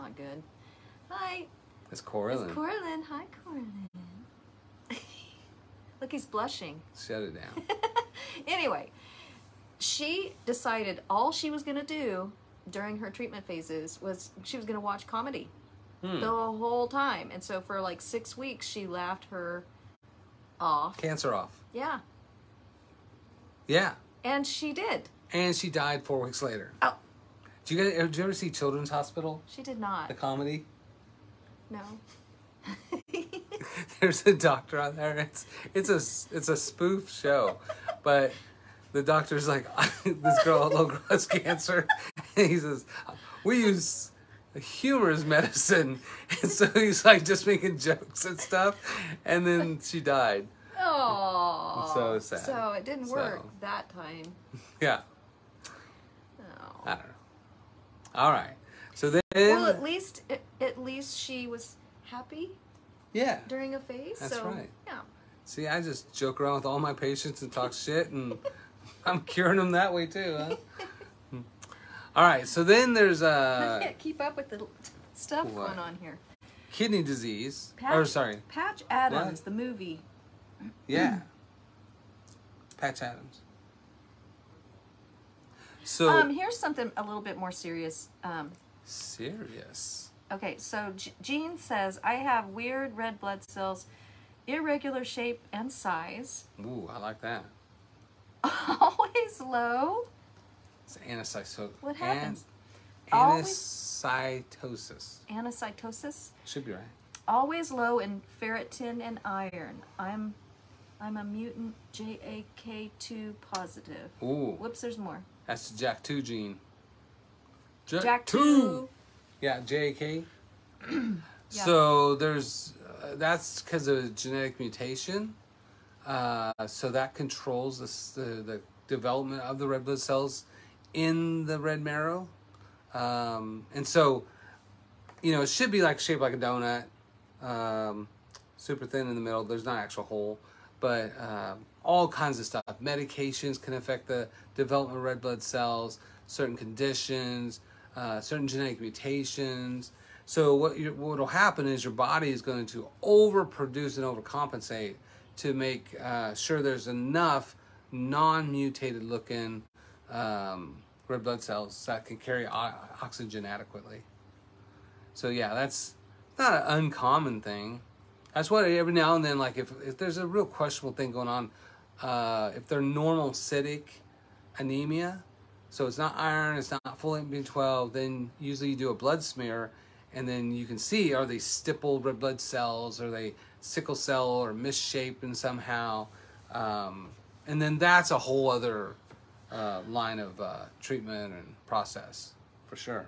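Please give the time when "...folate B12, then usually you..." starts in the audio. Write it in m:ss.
2:57.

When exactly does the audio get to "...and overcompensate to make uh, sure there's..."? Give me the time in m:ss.
2:33.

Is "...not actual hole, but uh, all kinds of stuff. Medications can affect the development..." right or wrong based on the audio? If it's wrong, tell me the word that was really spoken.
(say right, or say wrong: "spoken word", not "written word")
right.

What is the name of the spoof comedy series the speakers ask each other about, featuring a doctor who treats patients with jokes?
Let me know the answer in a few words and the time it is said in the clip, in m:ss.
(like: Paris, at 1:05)
Children's Hospital, at 0:28.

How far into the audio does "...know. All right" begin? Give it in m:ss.
0:57.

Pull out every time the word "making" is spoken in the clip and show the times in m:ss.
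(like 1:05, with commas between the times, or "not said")
0:47.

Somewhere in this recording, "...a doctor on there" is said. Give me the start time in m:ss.
0:34.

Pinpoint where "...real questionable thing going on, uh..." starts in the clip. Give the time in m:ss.
2:50.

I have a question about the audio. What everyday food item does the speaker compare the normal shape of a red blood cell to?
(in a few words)
Donut.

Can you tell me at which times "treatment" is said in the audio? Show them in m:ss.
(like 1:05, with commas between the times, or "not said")
0:13, 3:10.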